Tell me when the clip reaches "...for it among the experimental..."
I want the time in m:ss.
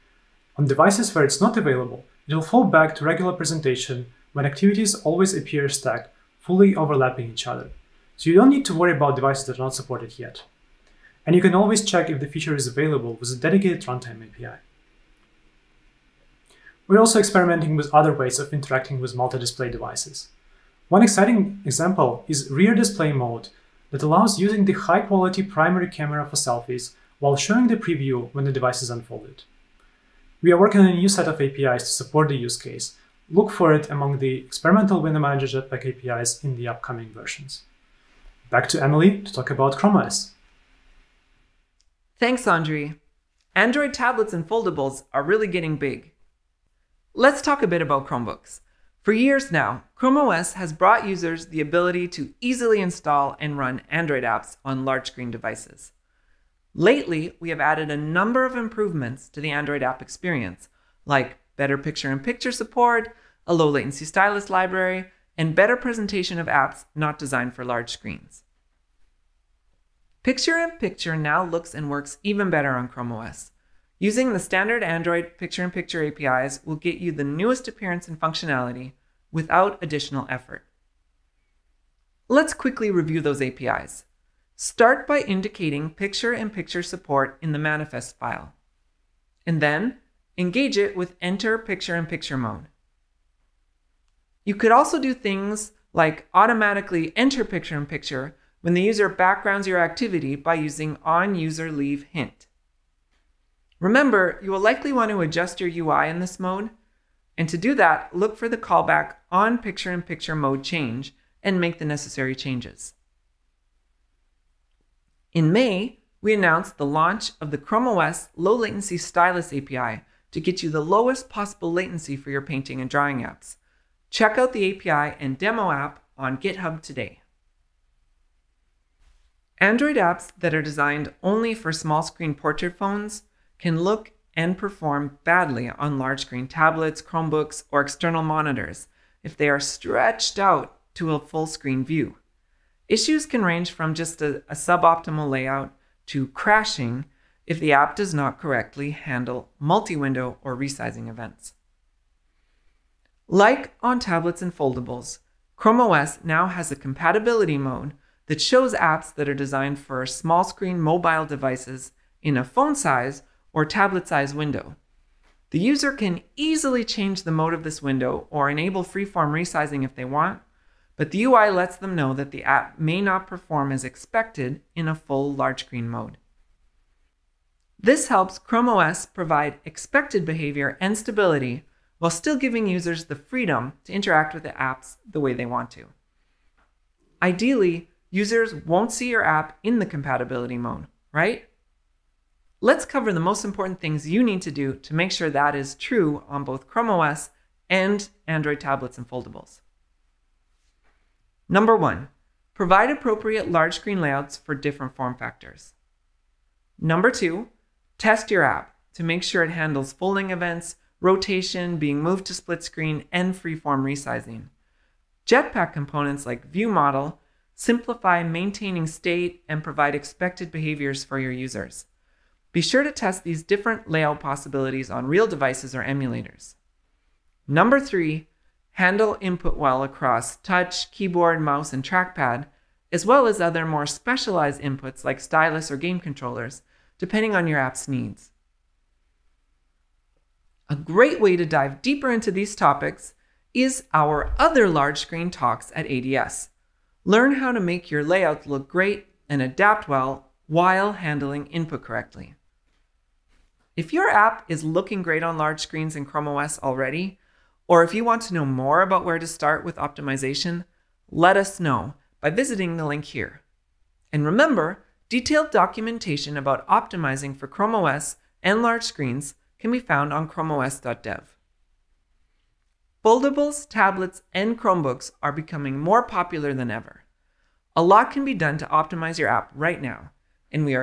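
0:33.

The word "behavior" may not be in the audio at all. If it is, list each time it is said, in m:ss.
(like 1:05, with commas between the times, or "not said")
3:00, 3:40.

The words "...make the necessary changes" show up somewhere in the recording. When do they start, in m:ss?
1:51.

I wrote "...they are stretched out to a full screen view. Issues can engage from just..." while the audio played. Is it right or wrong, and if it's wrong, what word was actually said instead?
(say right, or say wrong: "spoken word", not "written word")
wrong: "range", not "engage".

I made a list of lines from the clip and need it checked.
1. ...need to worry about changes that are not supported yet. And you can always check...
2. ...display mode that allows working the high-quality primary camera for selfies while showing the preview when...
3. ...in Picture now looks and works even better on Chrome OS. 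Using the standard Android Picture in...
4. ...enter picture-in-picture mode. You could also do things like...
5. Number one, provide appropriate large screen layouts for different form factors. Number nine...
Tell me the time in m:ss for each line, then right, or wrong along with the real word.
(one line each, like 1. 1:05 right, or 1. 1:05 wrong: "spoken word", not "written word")
1. 0:08 wrong: "devices", not "changes"
2. 0:22 wrong: "using", not "working"
3. 1:10 right
4. 1:31 right
5. 3:21 wrong: "two", not "nine".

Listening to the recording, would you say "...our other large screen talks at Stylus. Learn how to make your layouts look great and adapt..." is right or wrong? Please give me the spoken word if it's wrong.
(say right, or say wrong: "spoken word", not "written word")
wrong: "ADS", not "Stylus".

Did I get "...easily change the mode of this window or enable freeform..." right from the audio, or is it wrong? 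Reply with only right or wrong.
right.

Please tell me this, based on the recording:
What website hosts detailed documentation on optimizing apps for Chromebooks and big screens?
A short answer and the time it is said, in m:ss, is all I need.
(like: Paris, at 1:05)
chromeos.dev, at 4:30.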